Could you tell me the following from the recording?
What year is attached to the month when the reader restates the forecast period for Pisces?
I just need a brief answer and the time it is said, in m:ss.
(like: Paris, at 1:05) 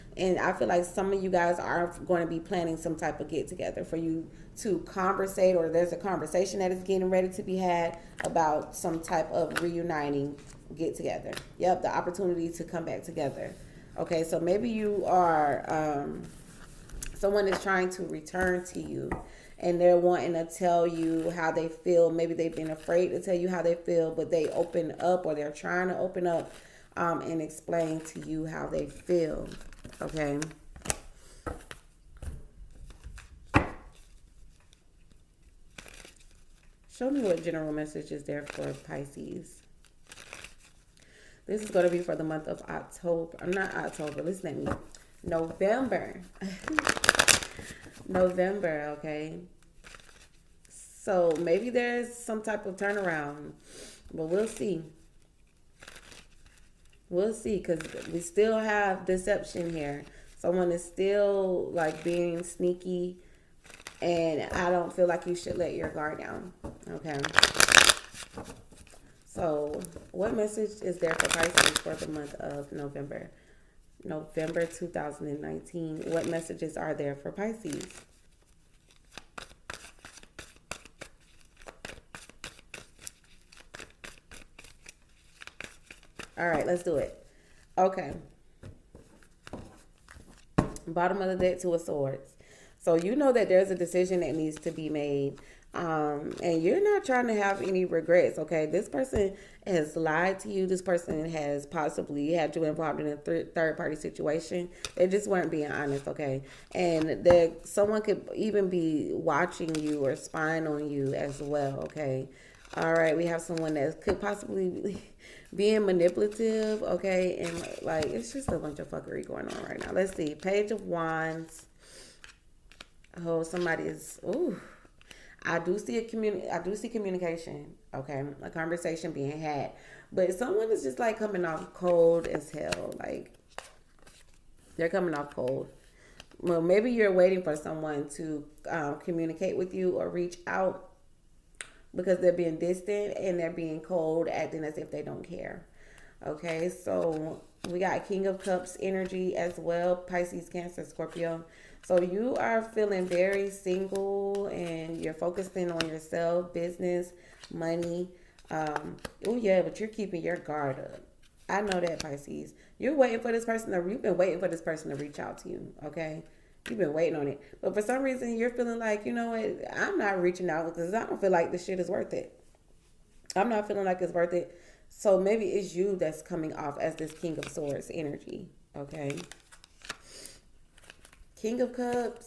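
2019, at 1:14.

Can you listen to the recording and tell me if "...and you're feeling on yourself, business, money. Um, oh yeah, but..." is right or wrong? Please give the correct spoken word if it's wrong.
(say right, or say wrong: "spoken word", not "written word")
wrong: "focusing", not "feeling".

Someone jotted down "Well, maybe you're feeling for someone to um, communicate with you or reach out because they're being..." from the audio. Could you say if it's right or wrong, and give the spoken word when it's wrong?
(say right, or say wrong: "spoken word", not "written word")
wrong: "waiting", not "feeling".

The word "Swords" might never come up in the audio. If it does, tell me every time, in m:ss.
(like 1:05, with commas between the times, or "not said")
1:31, 2:57.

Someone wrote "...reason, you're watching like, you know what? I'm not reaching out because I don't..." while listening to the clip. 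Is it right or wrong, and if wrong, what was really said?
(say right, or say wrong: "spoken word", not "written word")
wrong: "feeling", not "watching".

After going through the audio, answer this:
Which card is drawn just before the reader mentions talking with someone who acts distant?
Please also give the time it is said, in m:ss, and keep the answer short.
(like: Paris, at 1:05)
Page of Wands, at 2:00.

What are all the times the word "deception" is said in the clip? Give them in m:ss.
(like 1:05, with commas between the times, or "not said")
0:59.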